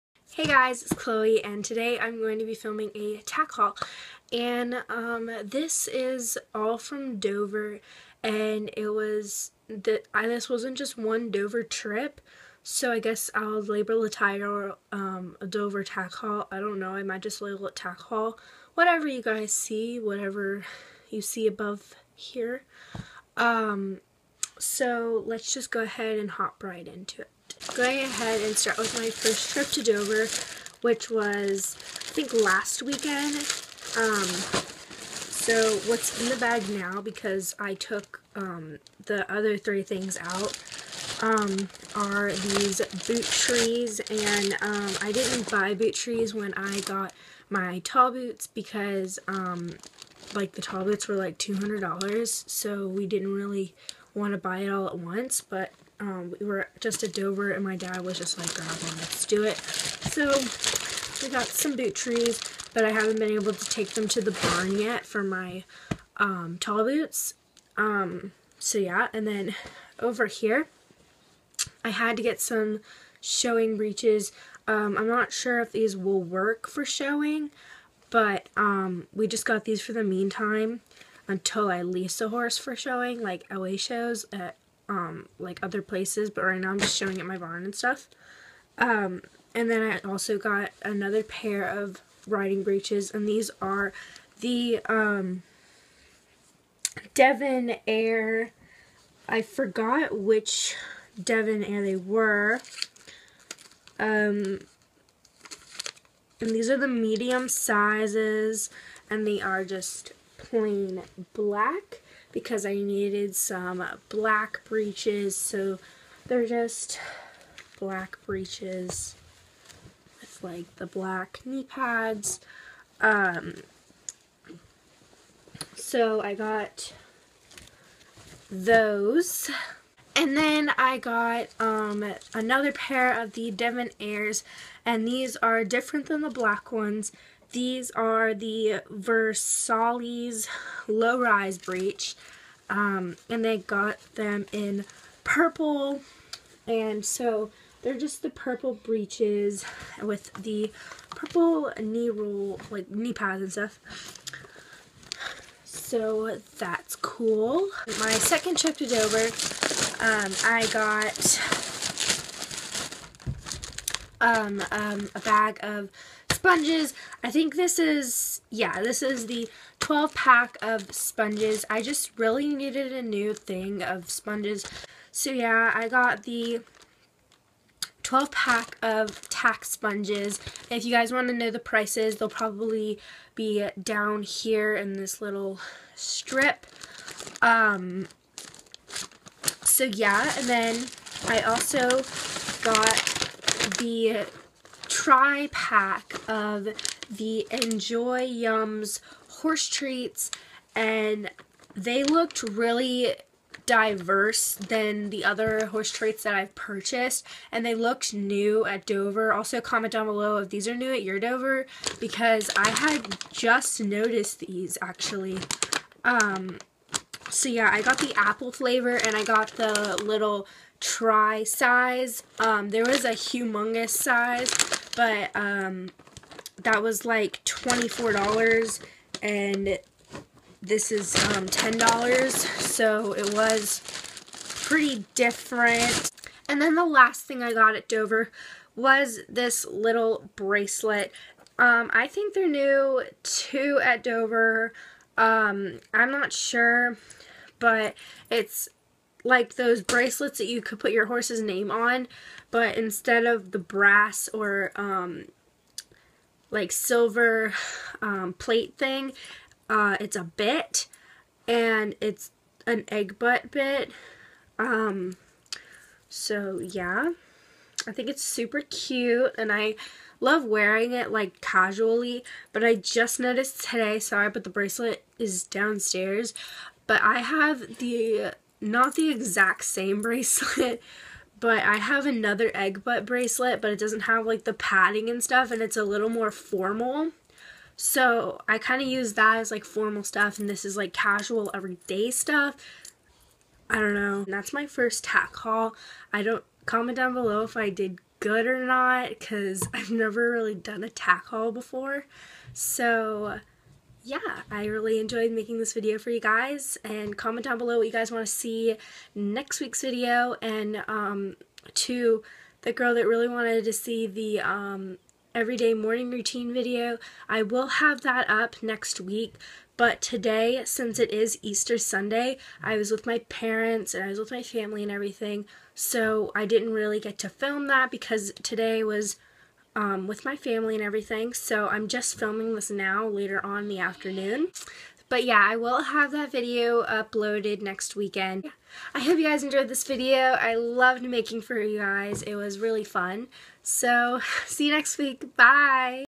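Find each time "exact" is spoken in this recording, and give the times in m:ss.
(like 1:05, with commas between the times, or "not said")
4:39.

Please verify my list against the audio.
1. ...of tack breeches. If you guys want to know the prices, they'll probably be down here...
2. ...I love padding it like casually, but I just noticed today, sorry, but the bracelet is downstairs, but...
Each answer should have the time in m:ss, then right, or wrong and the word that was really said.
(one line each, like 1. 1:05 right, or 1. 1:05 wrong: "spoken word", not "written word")
1. 2:58 wrong: "sponges", not "breeches"
2. 4:29 wrong: "wearing", not "padding".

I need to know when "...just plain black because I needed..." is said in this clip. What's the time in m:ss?
1:49.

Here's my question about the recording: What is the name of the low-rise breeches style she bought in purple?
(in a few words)
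Versailles.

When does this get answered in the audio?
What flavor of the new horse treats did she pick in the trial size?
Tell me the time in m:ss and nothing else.
3:38.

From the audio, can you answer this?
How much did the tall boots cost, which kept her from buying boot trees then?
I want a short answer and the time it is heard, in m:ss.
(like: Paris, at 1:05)
$200, at 0:51.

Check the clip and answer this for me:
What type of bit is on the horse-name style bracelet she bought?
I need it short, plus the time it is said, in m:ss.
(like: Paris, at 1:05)
egg butt bit, at 4:22.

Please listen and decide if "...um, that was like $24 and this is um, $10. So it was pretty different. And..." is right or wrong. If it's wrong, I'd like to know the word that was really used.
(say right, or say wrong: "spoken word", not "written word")
right.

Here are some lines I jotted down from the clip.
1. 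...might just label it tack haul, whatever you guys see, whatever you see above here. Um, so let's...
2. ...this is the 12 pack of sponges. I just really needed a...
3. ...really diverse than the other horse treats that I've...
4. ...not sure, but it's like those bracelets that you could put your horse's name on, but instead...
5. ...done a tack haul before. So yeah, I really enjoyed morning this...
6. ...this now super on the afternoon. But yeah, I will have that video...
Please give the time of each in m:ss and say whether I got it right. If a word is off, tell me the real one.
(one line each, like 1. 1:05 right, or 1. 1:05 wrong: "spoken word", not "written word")
1. 0:17 right
2. 2:48 right
3. 3:22 right
4. 4:06 right
5. 5:00 wrong: "making", not "morning"
6. 5:32 wrong: "later", not "super".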